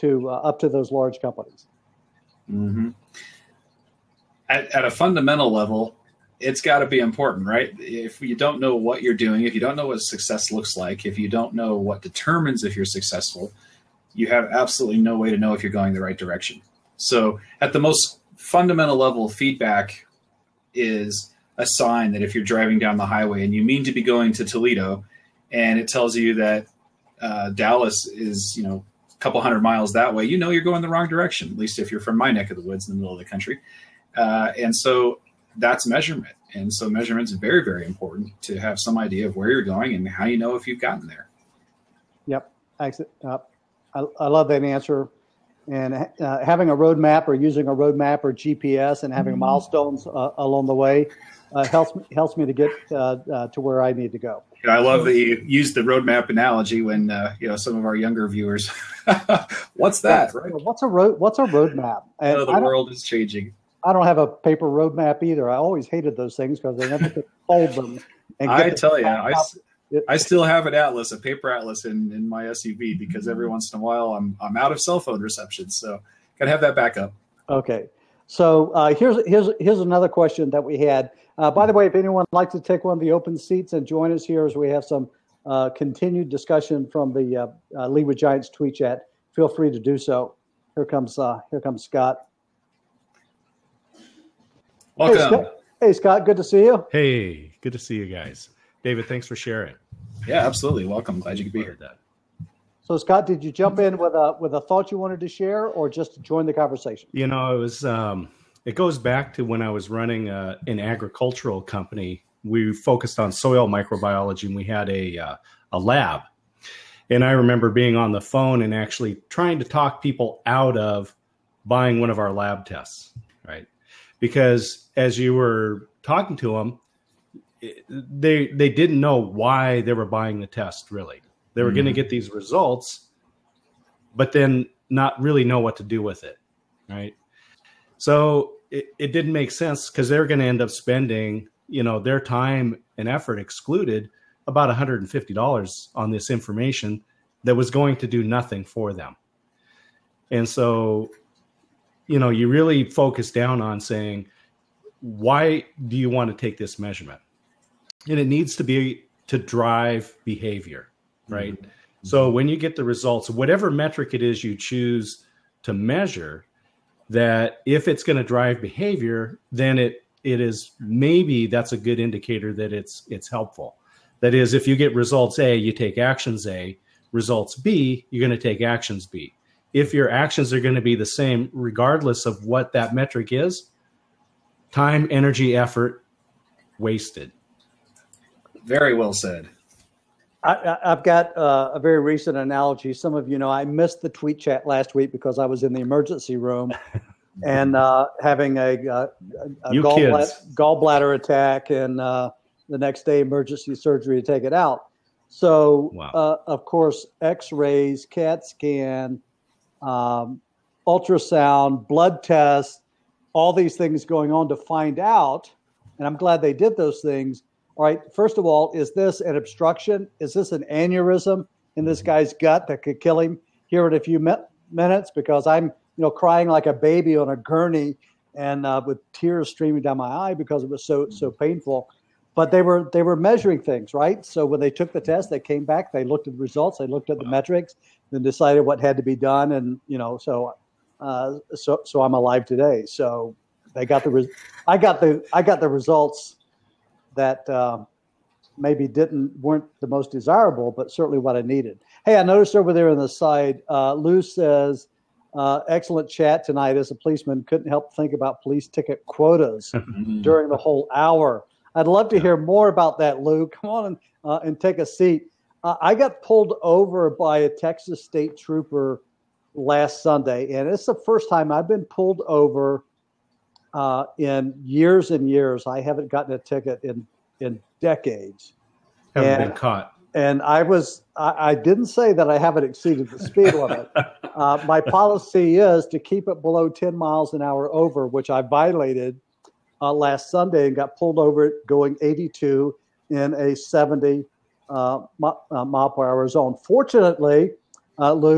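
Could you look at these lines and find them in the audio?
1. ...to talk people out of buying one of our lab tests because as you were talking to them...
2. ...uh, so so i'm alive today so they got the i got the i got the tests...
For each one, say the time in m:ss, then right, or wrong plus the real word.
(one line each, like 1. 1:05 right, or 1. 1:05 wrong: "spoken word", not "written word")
1. 1:59 right
2. 4:01 wrong: "results", not "tests".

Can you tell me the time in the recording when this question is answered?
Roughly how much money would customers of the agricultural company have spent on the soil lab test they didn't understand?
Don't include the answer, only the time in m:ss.
2:24.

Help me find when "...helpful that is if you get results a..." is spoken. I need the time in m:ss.
2:53.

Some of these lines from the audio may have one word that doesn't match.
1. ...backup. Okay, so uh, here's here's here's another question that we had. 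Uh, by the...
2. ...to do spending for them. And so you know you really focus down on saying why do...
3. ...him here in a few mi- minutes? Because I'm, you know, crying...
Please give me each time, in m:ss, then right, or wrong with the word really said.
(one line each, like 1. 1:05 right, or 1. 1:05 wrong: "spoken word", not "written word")
1. 1:16 right
2. 2:27 wrong: "nothing", not "spending"
3. 3:43 right.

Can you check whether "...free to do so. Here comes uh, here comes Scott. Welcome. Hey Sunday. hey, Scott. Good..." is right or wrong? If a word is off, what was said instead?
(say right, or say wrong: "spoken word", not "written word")
wrong: "Scott", not "Sunday".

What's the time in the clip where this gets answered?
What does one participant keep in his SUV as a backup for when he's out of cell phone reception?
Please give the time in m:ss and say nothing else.
1:11.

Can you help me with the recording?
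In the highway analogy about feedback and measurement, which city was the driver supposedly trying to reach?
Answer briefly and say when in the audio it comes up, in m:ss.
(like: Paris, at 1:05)
Toledo, at 0:24.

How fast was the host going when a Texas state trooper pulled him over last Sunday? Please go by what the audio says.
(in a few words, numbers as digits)
82 mph.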